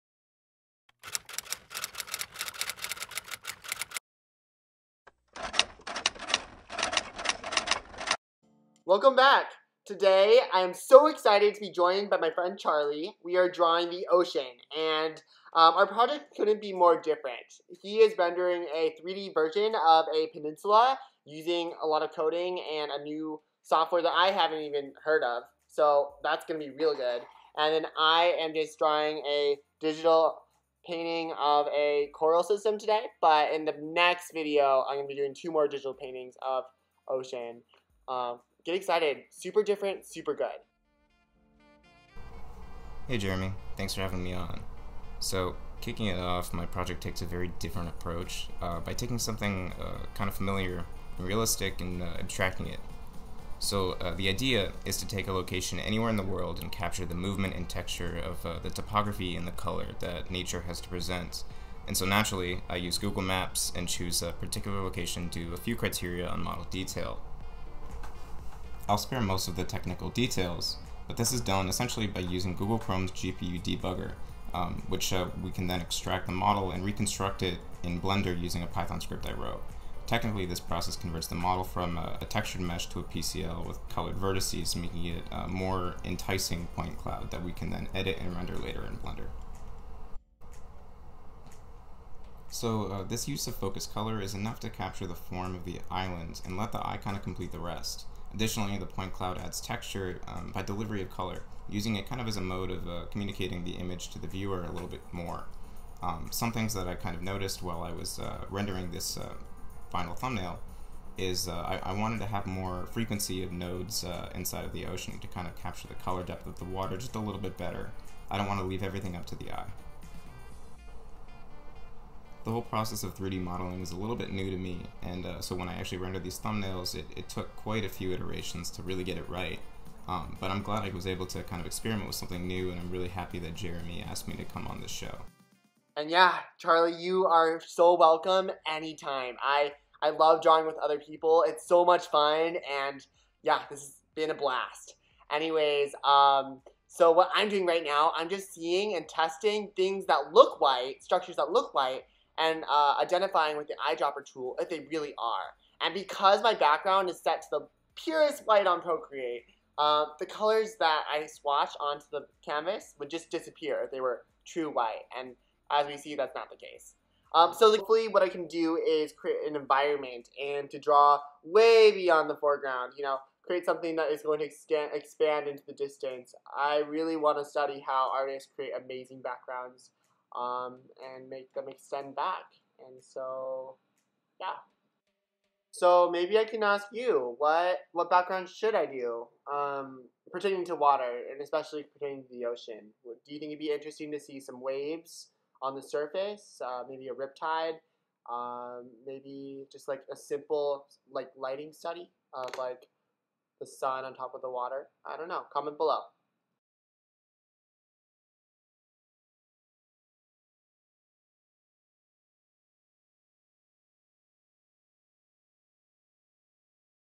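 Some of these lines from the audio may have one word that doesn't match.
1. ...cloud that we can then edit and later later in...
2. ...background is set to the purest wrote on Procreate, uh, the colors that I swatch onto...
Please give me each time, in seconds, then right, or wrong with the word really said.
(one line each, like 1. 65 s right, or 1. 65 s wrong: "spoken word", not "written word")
1. 86 s wrong: "render", not "later"
2. 156 s wrong: "white", not "wrote".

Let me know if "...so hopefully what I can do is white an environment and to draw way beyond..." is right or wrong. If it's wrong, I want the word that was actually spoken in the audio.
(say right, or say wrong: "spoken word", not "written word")
wrong: "create", not "white".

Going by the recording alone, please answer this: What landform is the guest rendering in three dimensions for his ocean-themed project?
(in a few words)
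Peninsula.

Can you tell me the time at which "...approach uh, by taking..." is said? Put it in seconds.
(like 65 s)
47 s.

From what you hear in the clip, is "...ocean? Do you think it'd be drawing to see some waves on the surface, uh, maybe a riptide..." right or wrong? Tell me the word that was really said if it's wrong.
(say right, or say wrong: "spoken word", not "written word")
wrong: "interesting", not "drawing".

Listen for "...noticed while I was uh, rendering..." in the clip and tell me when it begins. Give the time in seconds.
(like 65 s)
107 s.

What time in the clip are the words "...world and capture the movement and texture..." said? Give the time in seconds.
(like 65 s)
56 s.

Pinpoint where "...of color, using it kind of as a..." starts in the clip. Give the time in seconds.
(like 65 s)
101 s.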